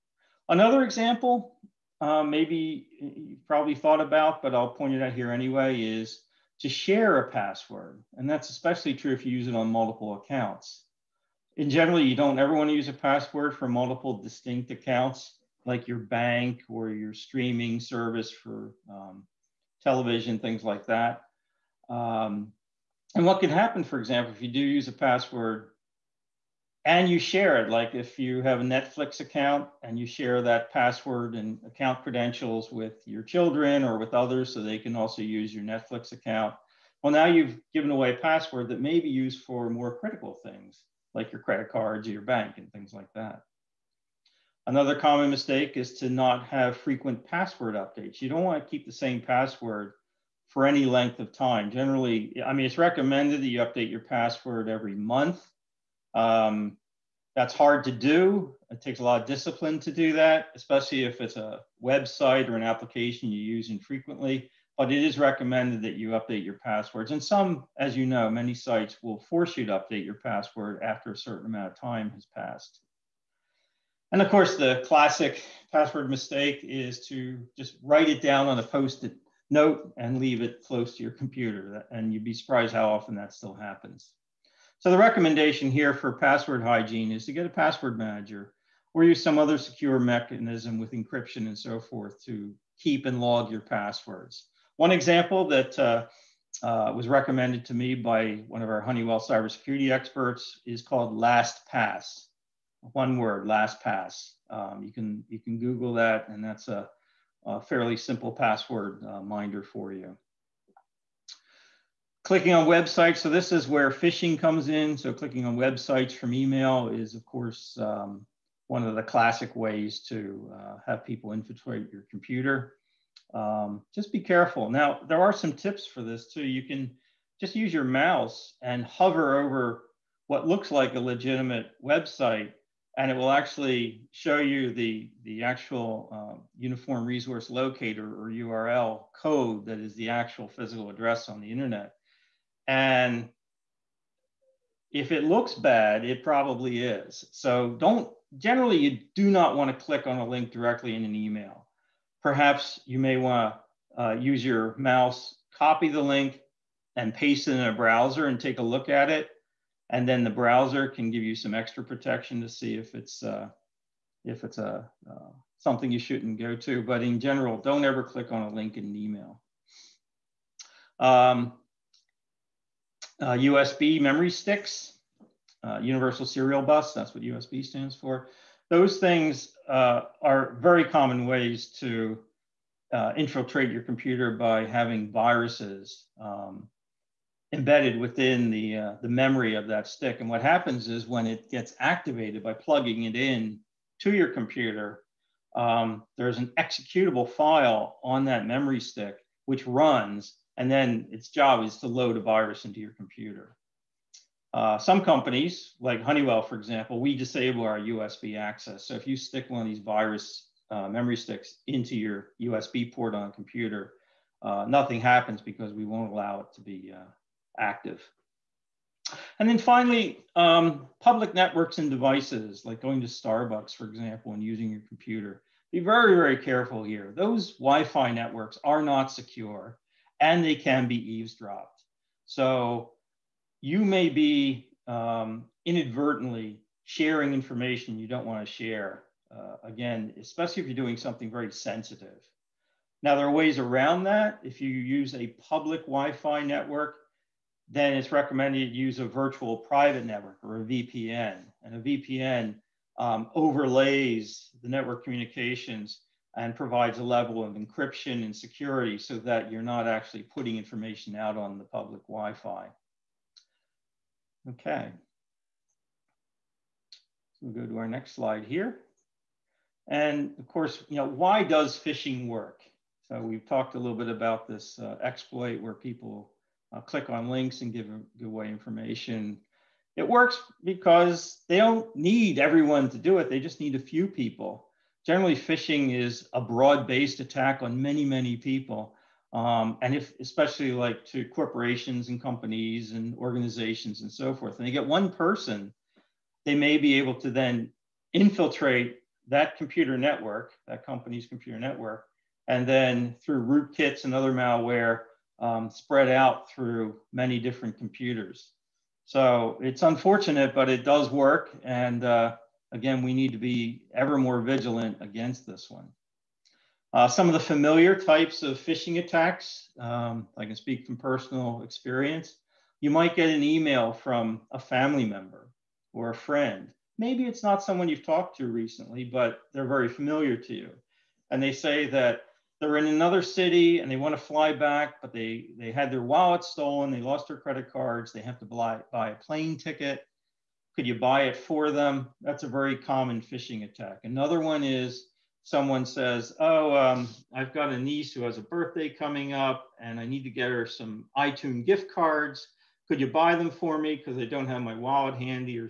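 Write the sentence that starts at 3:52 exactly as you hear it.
So you may be um, inadvertently sharing information you don't want to share.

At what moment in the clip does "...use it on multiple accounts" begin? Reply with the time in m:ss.
0:09.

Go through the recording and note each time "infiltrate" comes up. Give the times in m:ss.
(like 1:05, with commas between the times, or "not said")
2:01, 3:03, 4:58.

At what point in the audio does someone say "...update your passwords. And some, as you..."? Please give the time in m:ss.
1:06.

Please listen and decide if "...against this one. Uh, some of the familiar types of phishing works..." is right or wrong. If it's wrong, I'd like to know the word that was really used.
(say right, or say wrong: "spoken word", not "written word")
wrong: "attacks", not "works".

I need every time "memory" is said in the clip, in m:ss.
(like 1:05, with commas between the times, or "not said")
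2:54, 3:09, 3:18, 3:30.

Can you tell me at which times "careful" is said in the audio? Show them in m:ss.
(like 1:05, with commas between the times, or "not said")
2:04, 3:46.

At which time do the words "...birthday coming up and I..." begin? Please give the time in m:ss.
5:48.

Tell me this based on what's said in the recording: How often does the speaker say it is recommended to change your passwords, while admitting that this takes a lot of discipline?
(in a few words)
every month.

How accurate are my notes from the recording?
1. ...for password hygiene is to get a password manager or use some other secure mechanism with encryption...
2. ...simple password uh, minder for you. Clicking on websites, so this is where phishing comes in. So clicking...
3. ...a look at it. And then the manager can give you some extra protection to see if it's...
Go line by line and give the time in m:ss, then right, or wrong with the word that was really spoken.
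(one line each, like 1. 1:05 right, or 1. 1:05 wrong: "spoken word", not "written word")
1. 1:25 right
2. 1:47 right
3. 2:38 wrong: "browser", not "manager".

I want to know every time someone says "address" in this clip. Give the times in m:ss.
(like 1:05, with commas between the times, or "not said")
2:20.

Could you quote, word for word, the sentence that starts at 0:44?
Another common mistake is to not have frequent password updates.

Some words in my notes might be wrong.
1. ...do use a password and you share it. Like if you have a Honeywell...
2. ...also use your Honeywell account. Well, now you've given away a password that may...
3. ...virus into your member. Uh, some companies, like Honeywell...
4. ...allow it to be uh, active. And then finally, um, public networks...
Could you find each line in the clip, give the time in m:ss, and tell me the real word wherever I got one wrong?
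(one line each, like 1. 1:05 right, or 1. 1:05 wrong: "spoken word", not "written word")
1. 0:24 wrong: "Netflix", not "Honeywell"
2. 0:34 wrong: "Netflix", not "Honeywell"
3. 3:22 wrong: "computer", not "member"
4. 3:36 right.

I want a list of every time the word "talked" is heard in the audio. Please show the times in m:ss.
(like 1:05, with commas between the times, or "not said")
4:33, 5:28.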